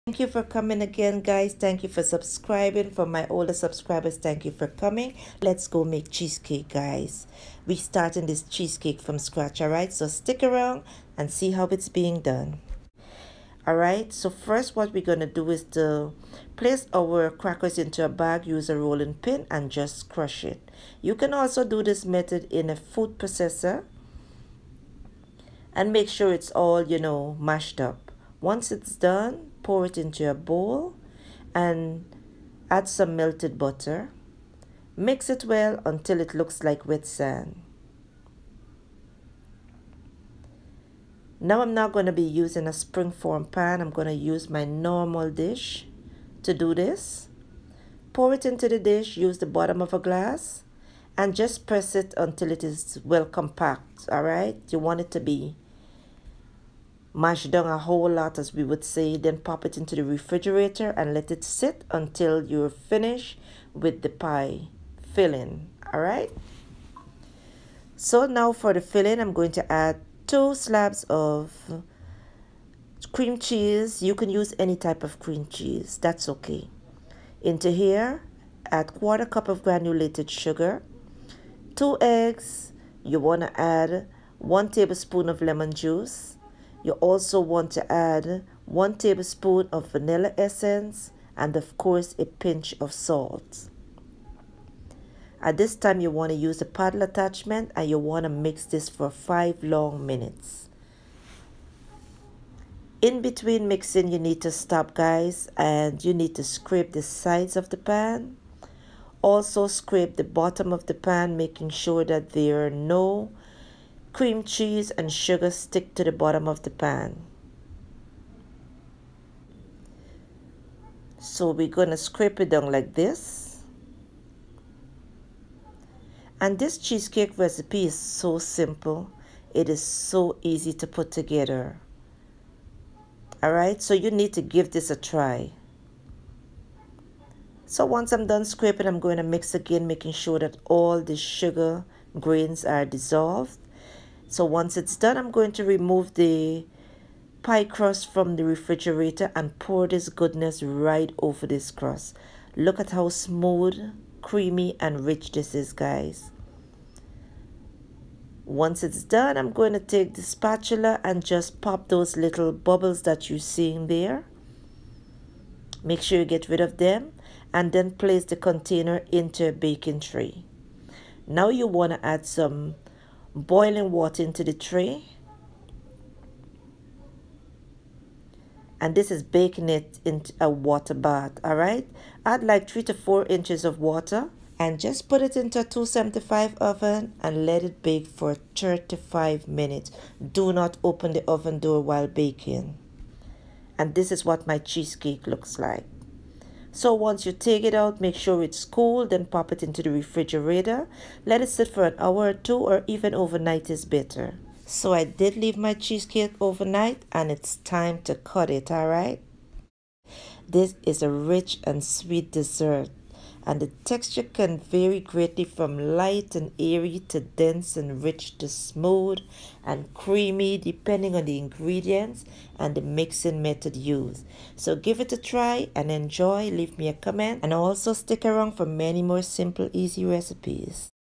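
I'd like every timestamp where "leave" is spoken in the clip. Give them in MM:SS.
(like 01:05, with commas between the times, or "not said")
03:25, 03:46.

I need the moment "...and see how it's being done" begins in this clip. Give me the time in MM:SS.
00:11.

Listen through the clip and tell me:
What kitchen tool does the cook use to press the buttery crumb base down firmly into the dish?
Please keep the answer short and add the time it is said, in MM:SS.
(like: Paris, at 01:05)
bottom of a glass, at 00:49.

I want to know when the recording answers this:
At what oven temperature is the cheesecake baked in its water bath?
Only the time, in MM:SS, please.
03:05.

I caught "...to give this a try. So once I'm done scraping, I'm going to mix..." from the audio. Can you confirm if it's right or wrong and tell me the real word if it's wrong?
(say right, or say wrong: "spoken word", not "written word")
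right.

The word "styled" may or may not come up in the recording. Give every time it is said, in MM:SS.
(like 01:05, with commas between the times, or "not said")
not said.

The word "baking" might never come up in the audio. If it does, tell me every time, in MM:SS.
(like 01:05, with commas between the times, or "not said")
02:49, 02:59, 03:12.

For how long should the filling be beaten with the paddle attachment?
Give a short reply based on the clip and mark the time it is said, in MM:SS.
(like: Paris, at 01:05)
5 minutes, at 01:39.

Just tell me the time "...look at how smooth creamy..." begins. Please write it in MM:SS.
02:32.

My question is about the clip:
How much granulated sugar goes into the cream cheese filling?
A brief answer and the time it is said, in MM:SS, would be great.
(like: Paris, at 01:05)
1/4 cup, at 01:18.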